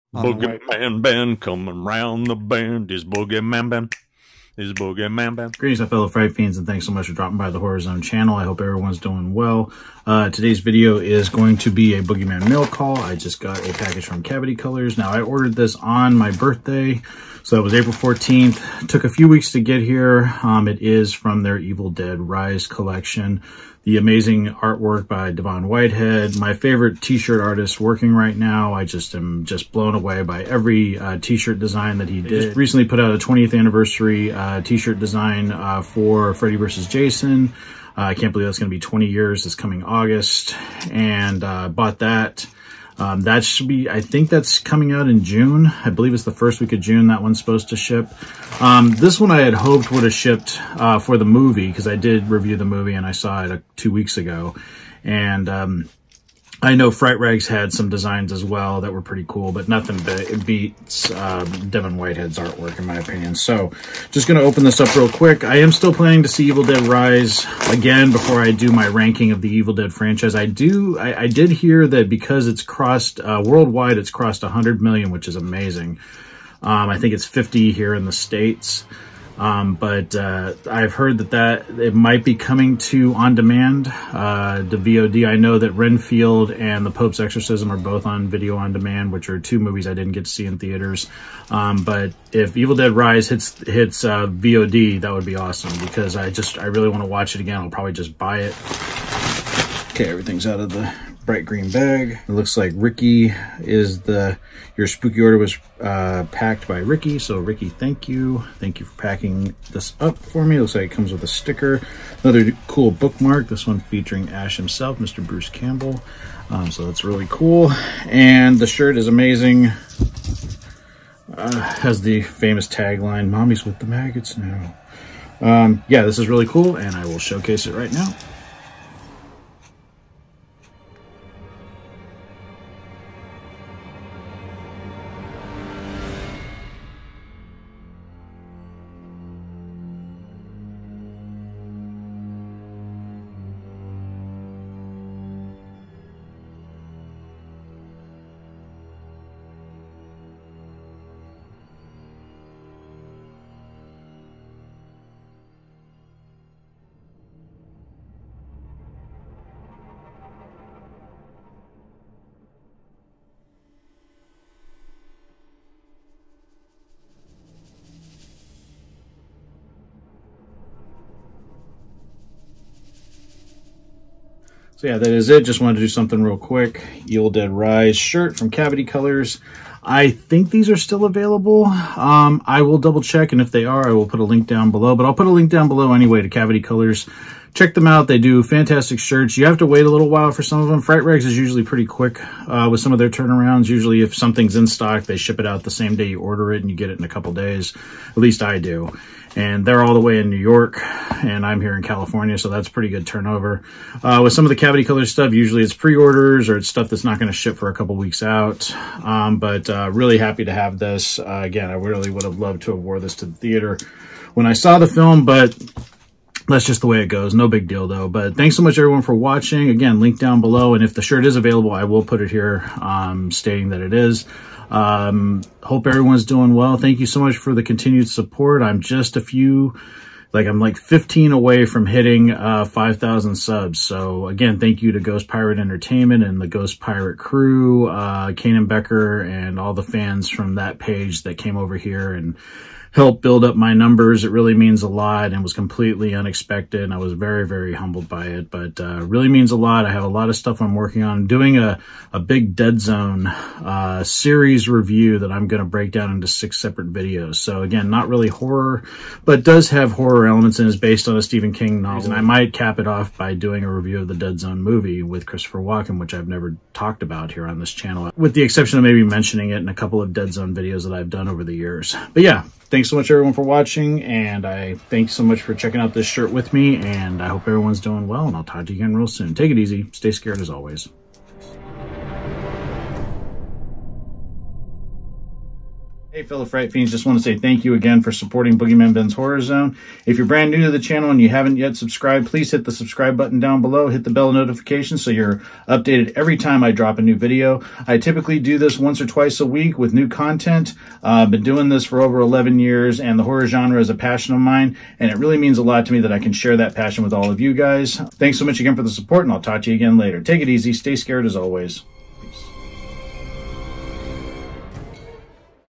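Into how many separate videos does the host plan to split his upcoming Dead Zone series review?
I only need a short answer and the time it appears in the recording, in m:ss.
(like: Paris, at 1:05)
6, at 4:16.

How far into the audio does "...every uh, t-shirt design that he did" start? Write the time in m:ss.
0:30.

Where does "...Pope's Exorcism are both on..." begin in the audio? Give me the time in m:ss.
1:26.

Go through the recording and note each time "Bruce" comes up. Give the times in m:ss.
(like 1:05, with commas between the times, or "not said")
1:55.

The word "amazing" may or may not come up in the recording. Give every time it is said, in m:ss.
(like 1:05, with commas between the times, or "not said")
0:23, 1:15, 1:59.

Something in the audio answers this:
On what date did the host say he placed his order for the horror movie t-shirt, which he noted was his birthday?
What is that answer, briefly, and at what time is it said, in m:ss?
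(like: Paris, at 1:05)
April 14th, at 0:17.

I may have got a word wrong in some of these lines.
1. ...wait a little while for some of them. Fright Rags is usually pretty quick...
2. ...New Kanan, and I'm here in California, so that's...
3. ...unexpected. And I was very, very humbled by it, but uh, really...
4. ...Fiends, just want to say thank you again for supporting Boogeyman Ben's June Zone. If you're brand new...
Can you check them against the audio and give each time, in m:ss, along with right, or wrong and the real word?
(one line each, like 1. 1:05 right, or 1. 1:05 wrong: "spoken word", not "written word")
1. 3:09 right
2. 3:20 wrong: "York", not "Kanan"
3. 4:06 right
4. 4:46 wrong: "Horror", not "June".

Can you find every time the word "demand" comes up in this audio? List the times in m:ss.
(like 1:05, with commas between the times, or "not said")
1:23, 1:28.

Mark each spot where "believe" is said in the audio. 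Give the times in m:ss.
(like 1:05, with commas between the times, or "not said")
0:38, 0:45.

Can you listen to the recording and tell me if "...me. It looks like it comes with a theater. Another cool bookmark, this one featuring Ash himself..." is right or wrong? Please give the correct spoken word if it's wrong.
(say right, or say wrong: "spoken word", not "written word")
wrong: "sticker", not "theater".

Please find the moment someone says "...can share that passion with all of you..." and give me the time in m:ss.
5:06.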